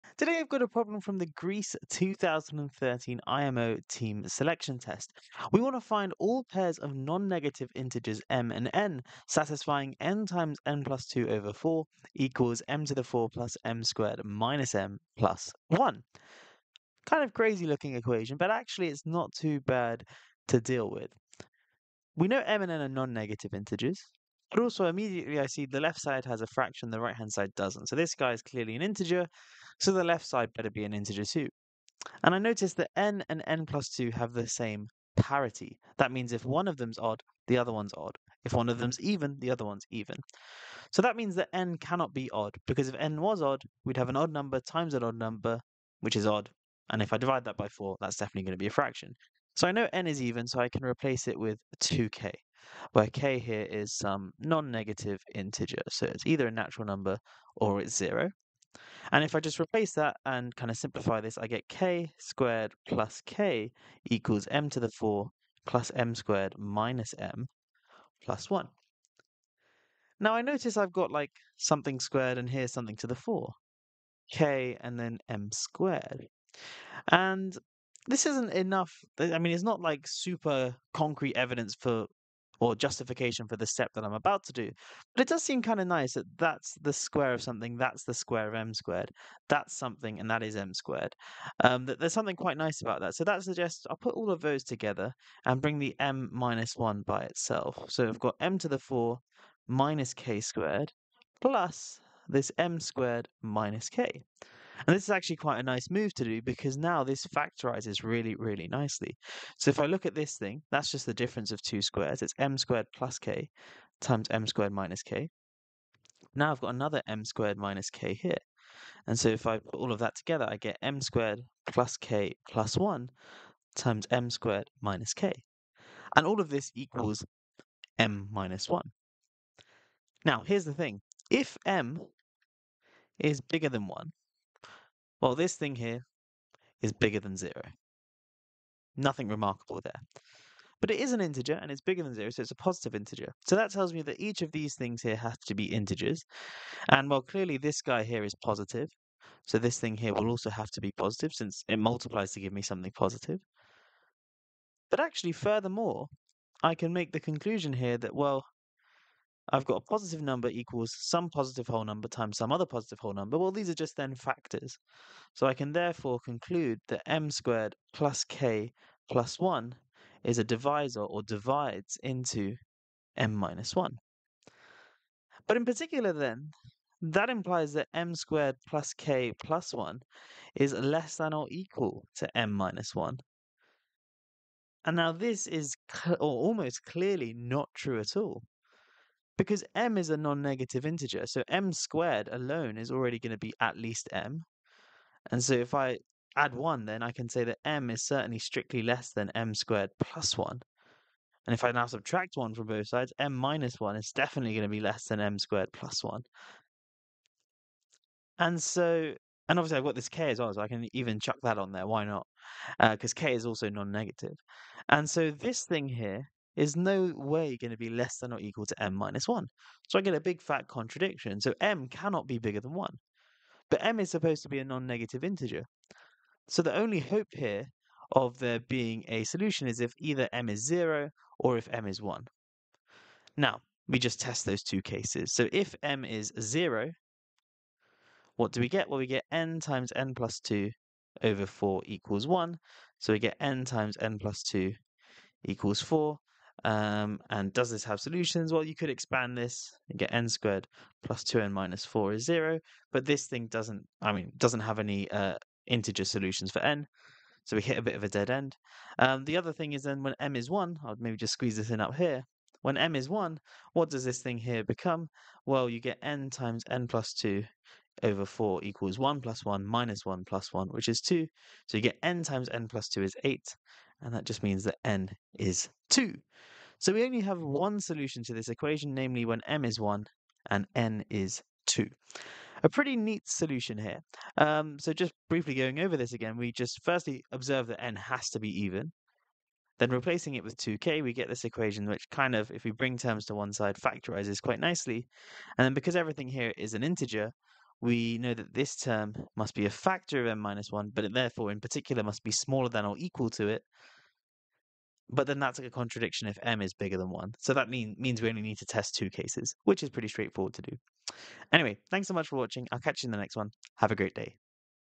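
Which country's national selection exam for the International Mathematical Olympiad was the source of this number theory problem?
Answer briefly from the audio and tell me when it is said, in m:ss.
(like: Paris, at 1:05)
Greece, at 0:01.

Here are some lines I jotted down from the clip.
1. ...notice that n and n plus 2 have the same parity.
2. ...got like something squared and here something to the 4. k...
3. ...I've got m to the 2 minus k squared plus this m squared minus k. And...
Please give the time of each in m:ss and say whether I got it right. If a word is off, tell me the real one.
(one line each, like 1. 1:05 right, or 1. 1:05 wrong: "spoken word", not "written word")
1. 0:32 right
2. 1:10 right
3. 1:38 wrong: "4", not "2".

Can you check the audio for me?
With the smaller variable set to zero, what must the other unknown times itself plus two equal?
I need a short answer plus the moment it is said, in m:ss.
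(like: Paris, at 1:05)
4, at 4:05.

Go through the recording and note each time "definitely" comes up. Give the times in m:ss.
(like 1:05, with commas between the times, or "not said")
0:48, 3:24.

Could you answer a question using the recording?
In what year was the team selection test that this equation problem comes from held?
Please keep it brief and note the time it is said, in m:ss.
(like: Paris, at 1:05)
2013, at 0:01.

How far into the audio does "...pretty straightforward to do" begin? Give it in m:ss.
5:09.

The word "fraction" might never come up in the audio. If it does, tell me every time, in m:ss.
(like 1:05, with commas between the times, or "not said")
0:26, 0:48.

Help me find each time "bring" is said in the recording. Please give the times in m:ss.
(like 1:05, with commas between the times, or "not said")
1:35, 4:52.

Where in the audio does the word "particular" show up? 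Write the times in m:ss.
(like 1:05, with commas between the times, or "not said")
2:55, 5:01.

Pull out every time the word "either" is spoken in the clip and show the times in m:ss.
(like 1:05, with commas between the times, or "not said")
0:56, 3:49.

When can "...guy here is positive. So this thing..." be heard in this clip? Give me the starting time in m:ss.
2:27.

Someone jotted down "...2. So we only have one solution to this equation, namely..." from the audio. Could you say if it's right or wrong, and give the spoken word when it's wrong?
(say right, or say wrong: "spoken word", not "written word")
right.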